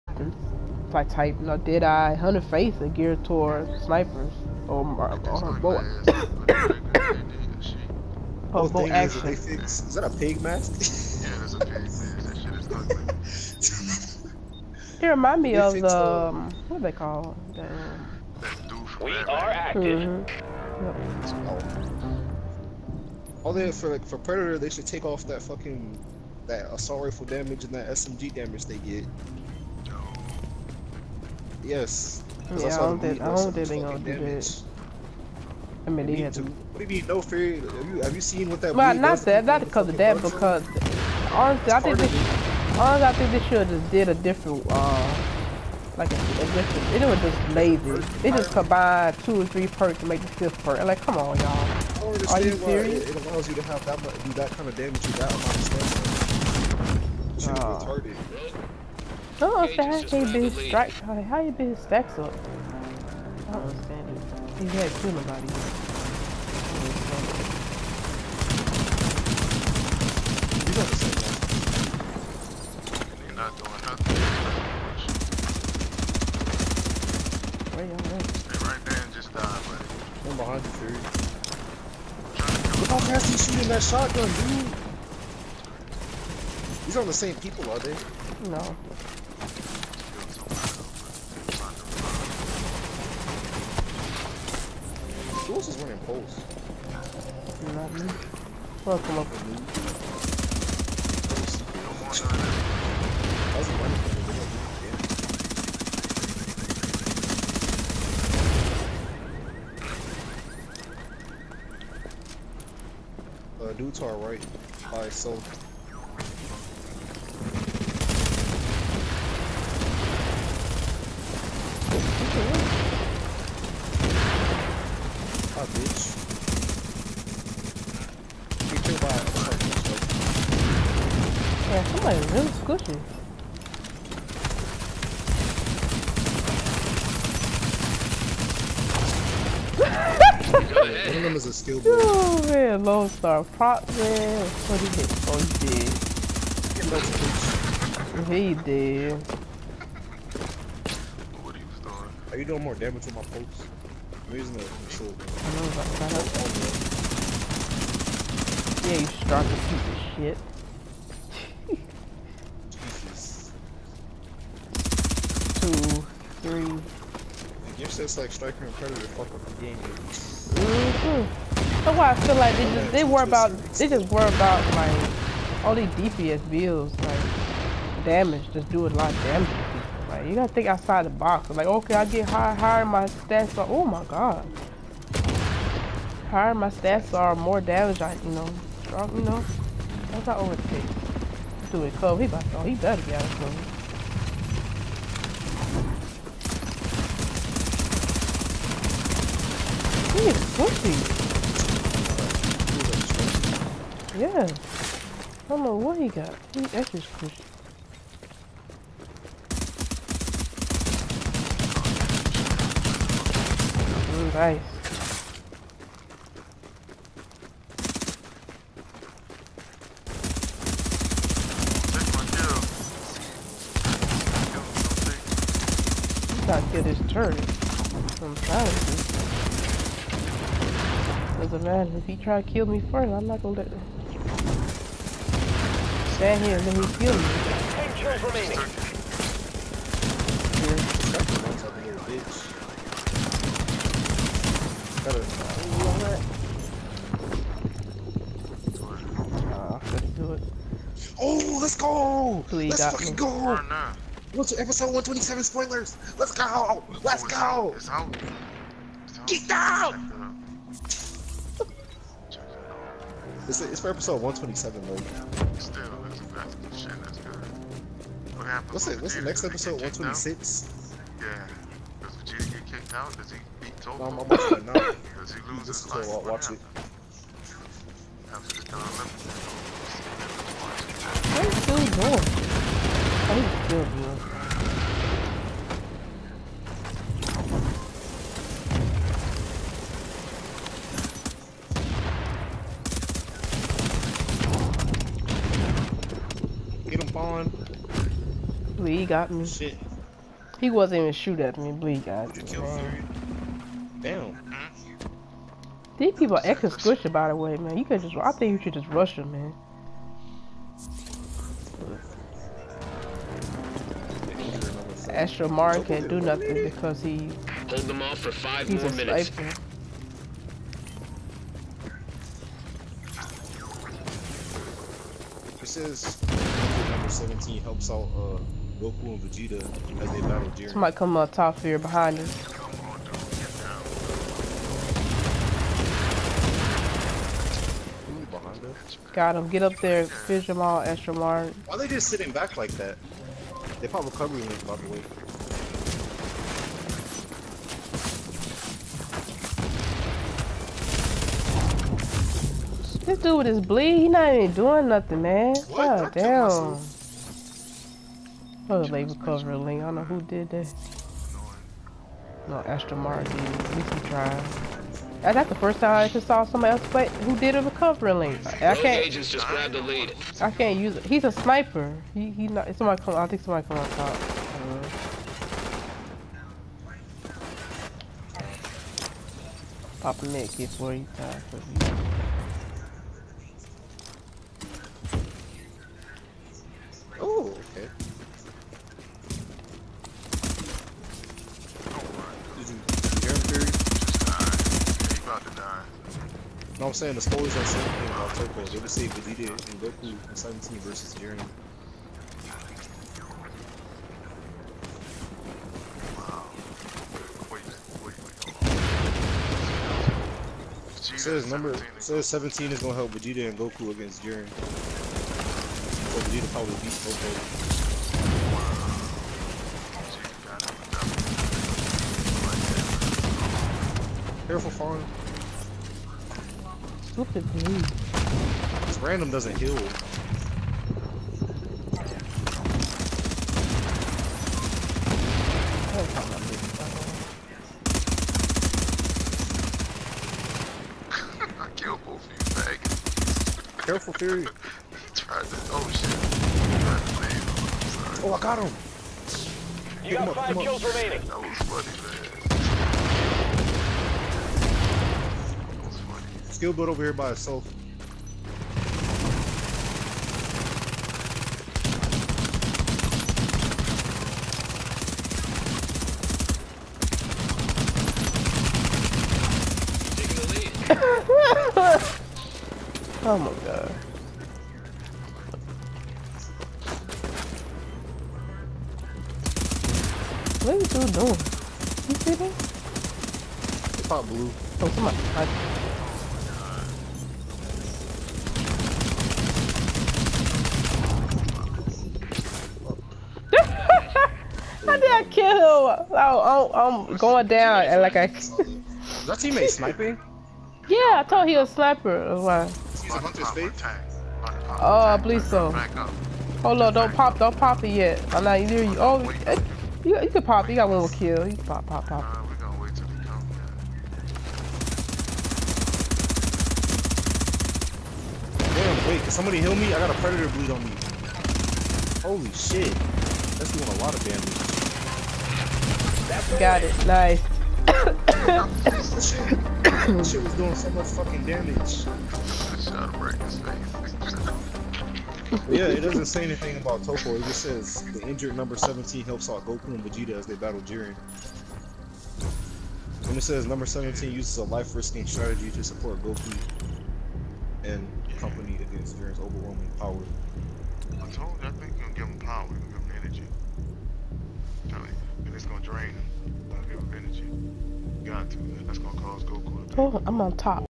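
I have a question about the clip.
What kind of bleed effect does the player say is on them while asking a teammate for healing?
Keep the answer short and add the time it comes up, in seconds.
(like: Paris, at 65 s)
predator bleed, at 520 s.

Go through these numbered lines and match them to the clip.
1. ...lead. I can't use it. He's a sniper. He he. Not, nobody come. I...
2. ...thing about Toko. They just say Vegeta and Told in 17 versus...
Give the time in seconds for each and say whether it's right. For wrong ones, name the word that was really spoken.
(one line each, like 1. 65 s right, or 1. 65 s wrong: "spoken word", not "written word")
1. 369 s wrong: "somebody", not "nobody"
2. 397 s wrong: "Goku", not "Told".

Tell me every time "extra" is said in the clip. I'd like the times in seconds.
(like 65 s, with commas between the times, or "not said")
206 s, 306 s, 340 s.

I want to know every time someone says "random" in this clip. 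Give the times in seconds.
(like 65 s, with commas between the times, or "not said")
429 s.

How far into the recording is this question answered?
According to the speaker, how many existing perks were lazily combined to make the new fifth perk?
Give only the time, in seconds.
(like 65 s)
49 s.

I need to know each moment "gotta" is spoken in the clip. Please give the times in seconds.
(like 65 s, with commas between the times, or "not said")
70 s, 180 s, 226 s.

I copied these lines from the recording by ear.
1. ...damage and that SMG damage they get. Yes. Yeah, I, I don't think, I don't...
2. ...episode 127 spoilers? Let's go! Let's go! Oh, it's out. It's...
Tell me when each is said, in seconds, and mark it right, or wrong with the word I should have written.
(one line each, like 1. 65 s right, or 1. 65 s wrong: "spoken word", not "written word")
1. 27 s right
2. 254 s right.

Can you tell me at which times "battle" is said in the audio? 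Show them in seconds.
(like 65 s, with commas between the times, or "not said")
330 s, 540 s.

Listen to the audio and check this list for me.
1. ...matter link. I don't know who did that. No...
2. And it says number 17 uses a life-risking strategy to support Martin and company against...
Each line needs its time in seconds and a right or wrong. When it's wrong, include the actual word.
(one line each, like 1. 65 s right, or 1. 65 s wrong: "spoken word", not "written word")
1. 359 s wrong: "cover", not "matter"
2. 543 s wrong: "Goku", not "Martin".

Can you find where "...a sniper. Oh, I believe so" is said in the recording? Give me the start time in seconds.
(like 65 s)
501 s.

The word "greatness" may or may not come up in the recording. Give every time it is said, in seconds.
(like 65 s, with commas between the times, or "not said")
not said.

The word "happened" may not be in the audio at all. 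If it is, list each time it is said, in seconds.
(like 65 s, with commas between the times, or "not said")
268 s.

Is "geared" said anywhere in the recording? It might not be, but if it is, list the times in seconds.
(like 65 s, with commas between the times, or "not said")
2 s.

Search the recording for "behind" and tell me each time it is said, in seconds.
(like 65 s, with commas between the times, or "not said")
80 s, 331 s.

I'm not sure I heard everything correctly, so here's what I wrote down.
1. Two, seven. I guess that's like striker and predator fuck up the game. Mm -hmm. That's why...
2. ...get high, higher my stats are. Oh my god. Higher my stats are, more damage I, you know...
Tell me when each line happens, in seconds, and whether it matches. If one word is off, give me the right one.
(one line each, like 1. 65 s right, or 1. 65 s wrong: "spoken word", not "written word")
1. 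165 s wrong: "three", not "seven"
2. 182 s right.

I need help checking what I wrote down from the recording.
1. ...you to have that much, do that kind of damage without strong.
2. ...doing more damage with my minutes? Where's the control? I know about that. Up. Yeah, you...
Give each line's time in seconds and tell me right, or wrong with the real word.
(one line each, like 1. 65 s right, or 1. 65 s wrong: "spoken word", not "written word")
1. 53 s wrong: "understanding", not "strong"
2. 152 s wrong: "pokes", not "minutes".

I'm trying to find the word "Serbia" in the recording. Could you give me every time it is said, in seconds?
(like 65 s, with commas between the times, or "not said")
not said.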